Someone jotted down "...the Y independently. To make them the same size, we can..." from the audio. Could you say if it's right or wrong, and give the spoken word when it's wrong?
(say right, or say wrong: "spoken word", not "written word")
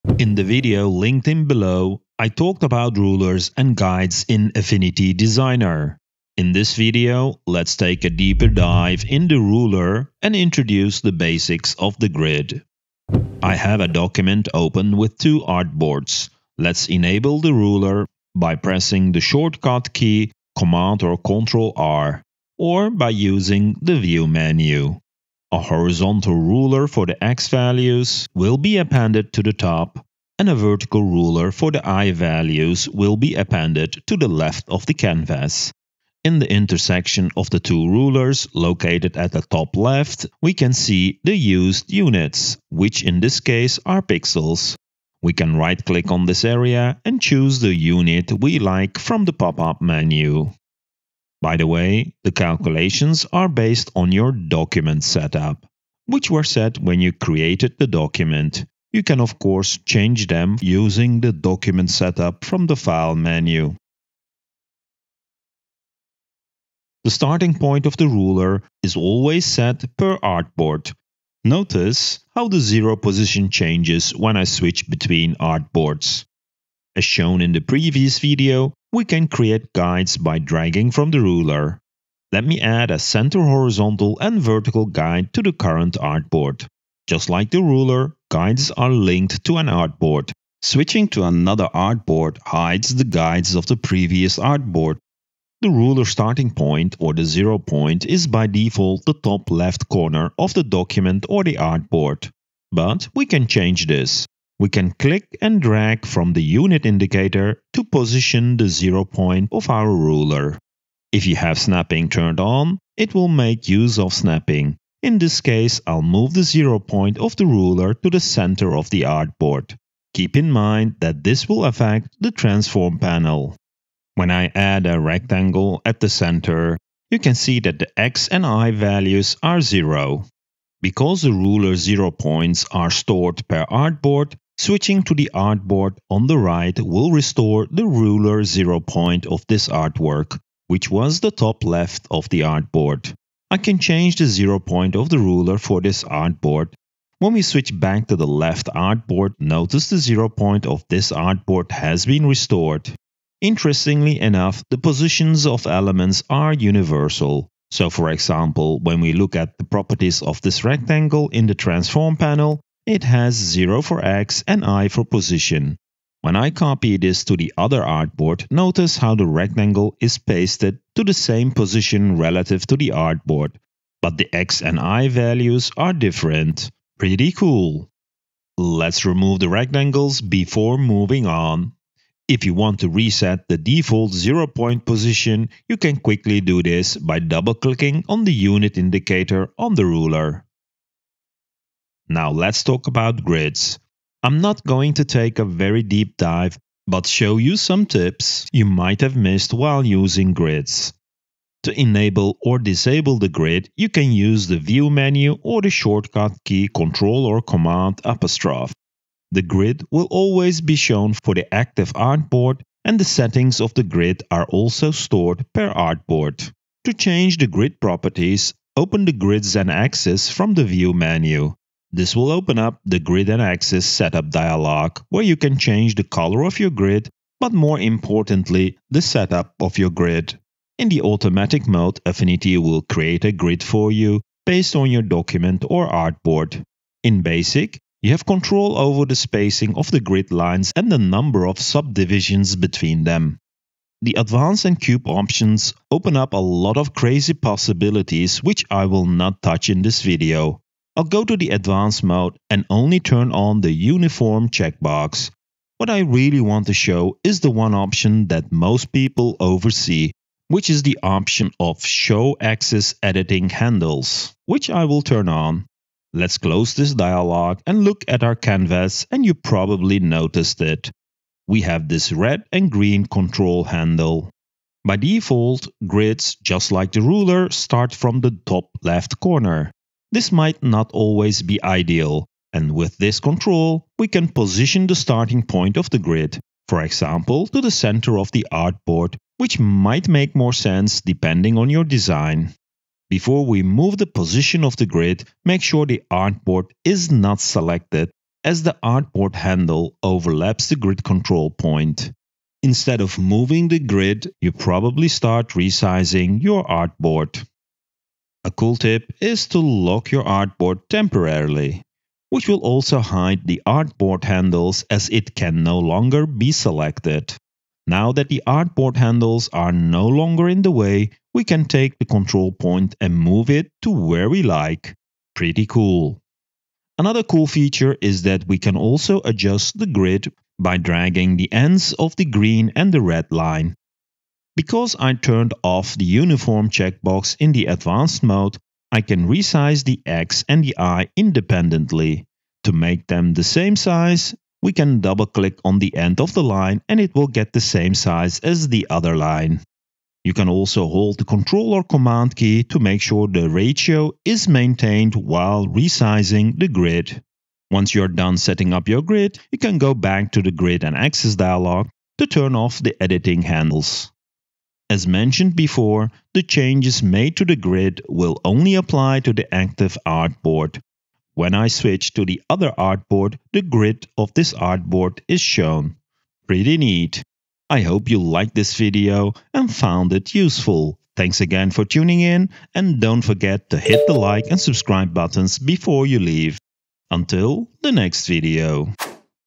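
right.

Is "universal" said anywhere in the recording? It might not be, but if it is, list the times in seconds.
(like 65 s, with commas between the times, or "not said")
156 s.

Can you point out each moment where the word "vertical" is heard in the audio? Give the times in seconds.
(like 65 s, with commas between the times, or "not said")
30 s, 84 s.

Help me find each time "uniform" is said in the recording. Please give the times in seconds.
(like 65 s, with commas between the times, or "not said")
253 s, 336 s.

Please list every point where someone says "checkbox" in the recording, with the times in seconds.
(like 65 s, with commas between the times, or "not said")
254 s, 336 s.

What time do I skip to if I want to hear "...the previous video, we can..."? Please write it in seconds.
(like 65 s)
77 s.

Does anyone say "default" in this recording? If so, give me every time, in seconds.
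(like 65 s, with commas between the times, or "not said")
98 s, 183 s, 274 s.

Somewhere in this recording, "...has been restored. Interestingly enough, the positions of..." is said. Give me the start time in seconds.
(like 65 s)
151 s.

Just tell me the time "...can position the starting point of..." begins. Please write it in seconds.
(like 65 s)
284 s.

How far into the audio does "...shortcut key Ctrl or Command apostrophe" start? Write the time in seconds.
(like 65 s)
205 s.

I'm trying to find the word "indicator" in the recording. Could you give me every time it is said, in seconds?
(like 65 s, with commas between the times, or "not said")
106 s, 188 s.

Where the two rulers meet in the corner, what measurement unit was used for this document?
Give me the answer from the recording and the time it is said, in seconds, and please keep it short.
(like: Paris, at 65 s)
pixels, at 44 s.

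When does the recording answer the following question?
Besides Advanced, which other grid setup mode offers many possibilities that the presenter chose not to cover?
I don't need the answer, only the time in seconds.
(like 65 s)
244 s.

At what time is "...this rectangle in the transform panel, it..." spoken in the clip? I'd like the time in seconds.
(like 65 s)
160 s.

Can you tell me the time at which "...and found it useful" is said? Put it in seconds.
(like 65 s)
379 s.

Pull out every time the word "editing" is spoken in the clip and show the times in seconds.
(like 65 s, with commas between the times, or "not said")
263 s, 363 s.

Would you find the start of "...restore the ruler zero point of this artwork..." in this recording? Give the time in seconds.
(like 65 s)
137 s.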